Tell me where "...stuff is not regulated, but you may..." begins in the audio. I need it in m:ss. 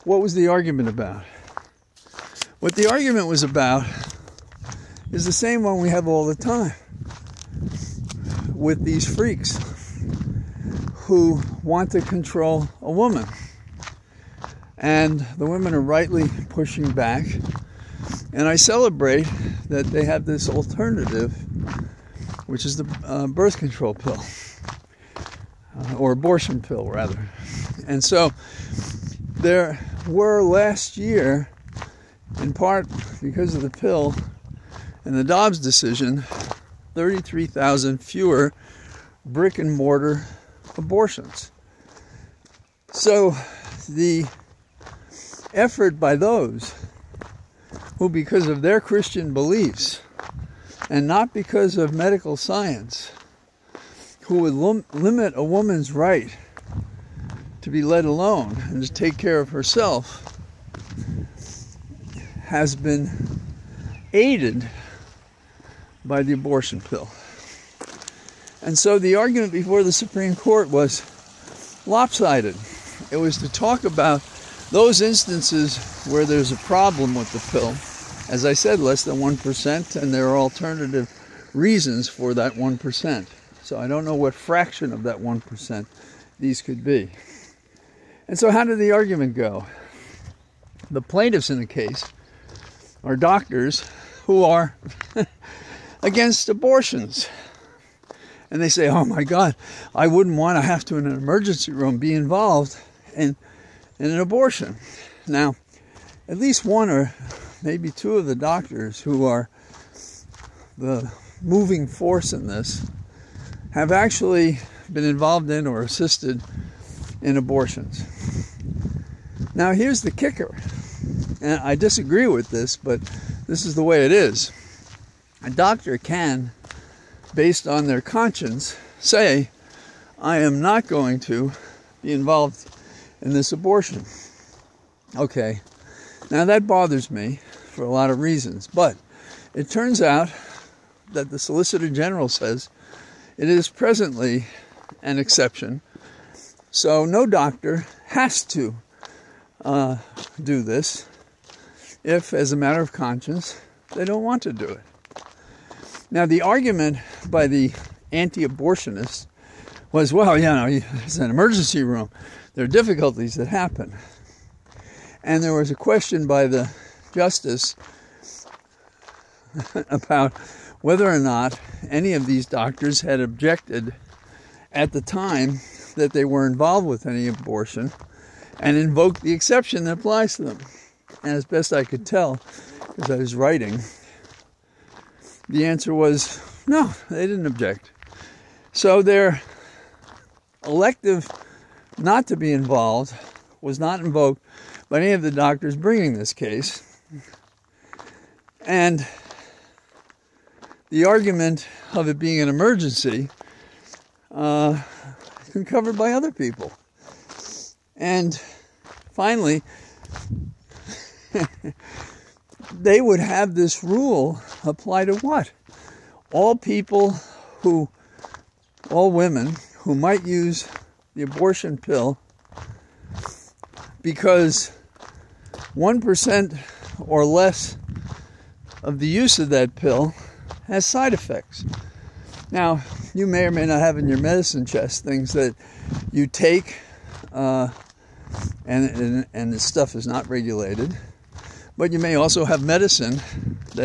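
3:59.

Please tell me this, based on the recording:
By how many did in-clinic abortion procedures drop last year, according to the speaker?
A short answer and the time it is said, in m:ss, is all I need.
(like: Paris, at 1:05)
33,000, at 0:36.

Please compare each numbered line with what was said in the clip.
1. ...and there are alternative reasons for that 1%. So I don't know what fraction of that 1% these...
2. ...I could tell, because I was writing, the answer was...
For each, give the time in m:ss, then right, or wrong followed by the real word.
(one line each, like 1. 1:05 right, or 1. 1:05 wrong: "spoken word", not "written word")
1. 1:20 right
2. 3:01 right.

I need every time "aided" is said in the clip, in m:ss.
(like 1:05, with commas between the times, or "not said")
1:04.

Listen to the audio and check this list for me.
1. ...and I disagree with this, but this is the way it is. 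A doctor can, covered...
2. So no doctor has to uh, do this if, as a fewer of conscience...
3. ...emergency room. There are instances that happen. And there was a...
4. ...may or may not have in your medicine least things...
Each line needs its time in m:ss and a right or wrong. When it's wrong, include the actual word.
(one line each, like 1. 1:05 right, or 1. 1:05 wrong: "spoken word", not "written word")
1. 2:01 wrong: "based", not "covered"
2. 2:26 wrong: "matter", not "fewer"
3. 2:41 wrong: "difficulties", not "instances"
4. 3:53 wrong: "chest", not "least".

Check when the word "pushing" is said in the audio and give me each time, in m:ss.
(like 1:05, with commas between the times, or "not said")
0:16.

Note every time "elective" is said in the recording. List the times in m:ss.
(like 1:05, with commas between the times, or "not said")
3:10.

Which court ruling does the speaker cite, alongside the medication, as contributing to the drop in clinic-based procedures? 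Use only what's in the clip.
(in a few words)
Dobbs decision.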